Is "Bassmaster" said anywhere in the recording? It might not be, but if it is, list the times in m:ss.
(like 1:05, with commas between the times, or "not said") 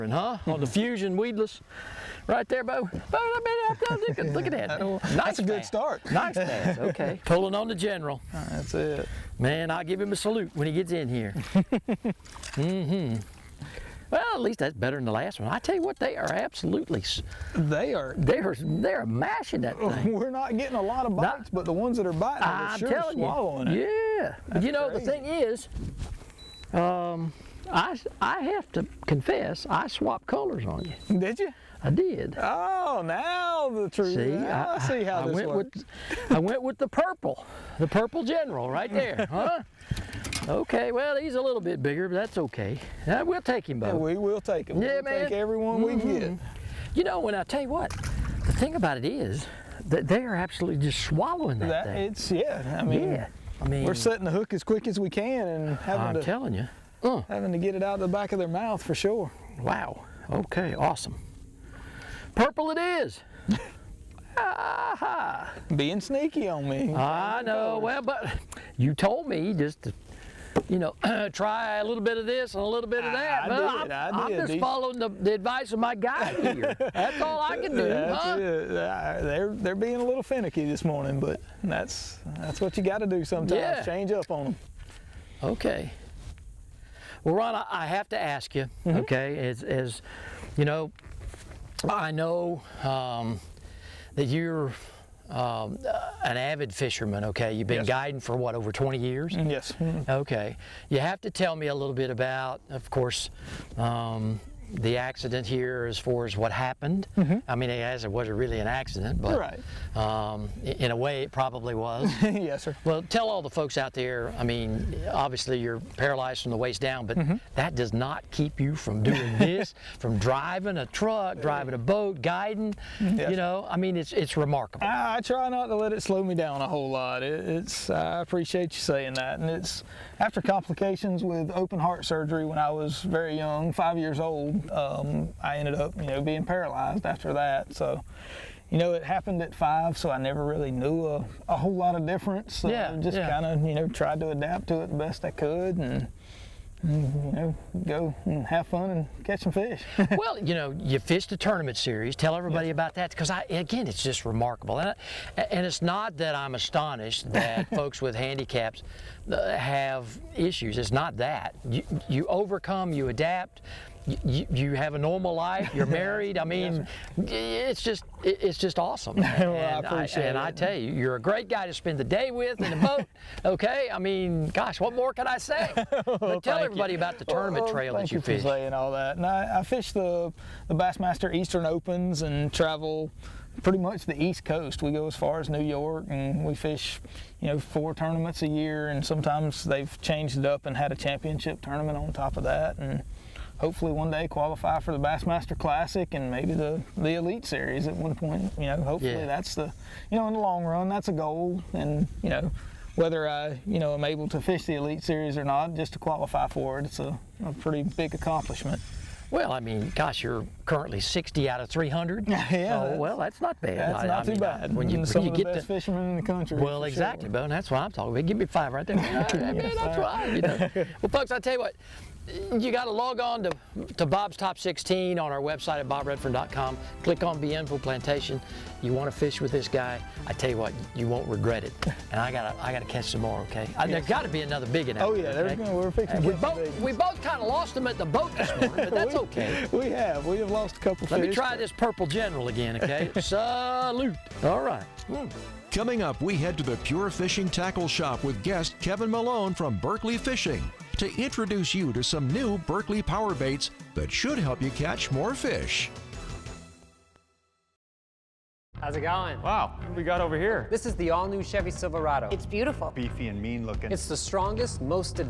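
3:00, 3:14.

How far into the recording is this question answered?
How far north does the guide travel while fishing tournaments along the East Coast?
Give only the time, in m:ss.
3:05.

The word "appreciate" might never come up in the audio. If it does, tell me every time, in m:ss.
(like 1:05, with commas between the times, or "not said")
2:08, 2:49.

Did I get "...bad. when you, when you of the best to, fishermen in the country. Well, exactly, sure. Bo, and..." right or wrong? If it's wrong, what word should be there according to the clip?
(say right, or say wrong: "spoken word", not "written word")
right.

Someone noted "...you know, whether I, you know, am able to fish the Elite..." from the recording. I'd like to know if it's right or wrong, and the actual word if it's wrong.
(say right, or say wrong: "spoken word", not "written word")
right.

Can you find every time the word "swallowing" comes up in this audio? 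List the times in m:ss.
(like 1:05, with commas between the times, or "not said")
0:23, 0:50.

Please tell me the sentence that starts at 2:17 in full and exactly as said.
So, you know, it happened at five, so I never really knew a, a whole lot of difference.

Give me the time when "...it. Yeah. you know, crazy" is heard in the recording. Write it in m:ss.
0:23.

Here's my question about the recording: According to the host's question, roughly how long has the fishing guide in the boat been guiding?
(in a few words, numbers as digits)
over 20 years.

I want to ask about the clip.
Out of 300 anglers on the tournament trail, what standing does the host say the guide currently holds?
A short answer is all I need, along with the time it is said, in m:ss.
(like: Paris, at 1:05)
60, at 3:31.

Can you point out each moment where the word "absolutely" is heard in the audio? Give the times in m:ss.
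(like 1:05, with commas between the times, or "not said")
0:16, 0:50.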